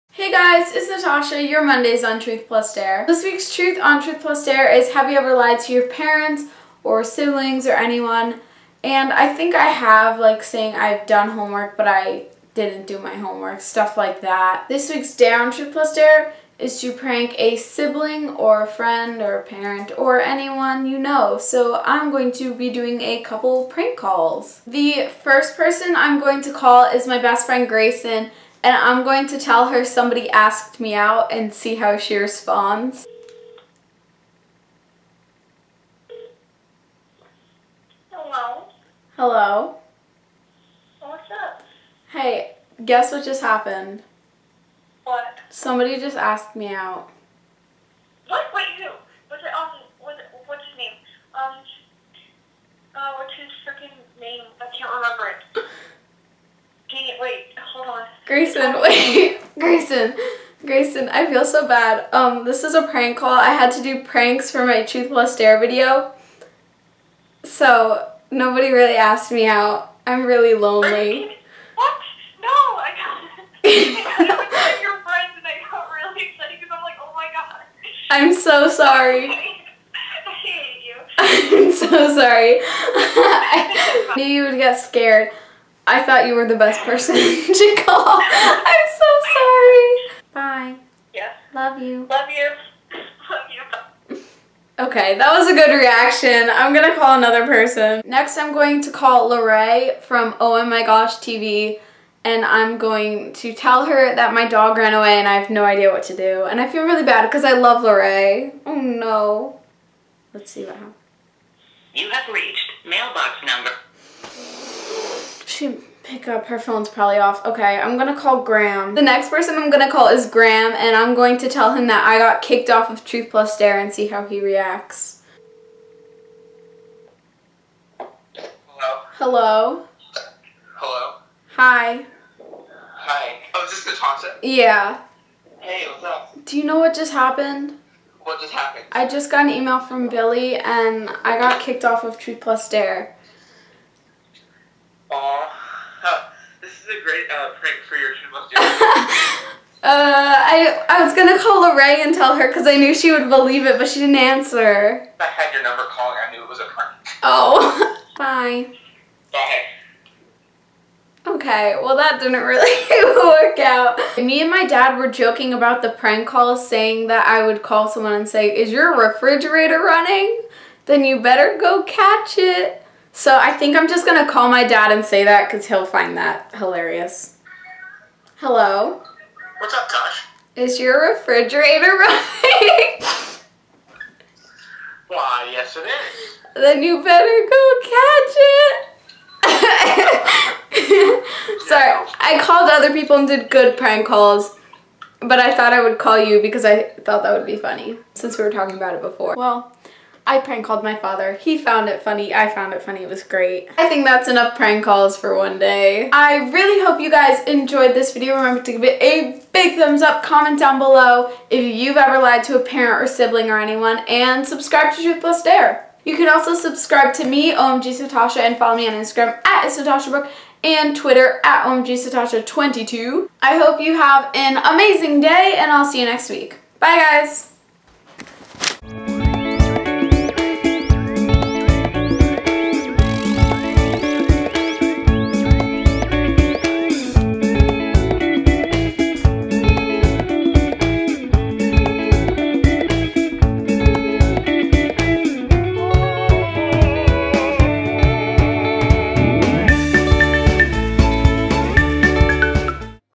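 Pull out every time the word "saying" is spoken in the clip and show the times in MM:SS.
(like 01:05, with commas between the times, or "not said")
00:10, 02:46.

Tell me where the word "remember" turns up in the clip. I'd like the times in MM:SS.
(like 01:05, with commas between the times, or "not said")
00:54, 03:28.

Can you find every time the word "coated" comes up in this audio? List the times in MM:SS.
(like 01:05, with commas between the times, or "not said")
not said.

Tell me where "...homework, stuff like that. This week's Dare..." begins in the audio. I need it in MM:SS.
00:13.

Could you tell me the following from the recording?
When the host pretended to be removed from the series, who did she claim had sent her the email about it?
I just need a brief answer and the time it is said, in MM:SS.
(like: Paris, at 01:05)
Billy, at 02:20.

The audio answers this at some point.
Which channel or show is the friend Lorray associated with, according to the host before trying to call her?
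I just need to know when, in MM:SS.
01:40.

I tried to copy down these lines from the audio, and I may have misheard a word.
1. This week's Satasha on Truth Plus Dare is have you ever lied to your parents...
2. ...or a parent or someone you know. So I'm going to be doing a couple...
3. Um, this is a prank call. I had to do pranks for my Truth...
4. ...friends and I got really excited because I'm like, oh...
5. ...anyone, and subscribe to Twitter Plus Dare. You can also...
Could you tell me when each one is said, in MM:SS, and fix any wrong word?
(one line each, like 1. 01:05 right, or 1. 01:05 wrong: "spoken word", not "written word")
1. 00:03 wrong: "Truth", not "Satasha"
2. 00:19 wrong: "anyone", not "someone"
3. 01:02 right
4. 01:14 right
5. 03:33 wrong: "Truth", not "Twitter".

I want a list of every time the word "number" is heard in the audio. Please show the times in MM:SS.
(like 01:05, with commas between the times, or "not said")
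01:53, 02:35.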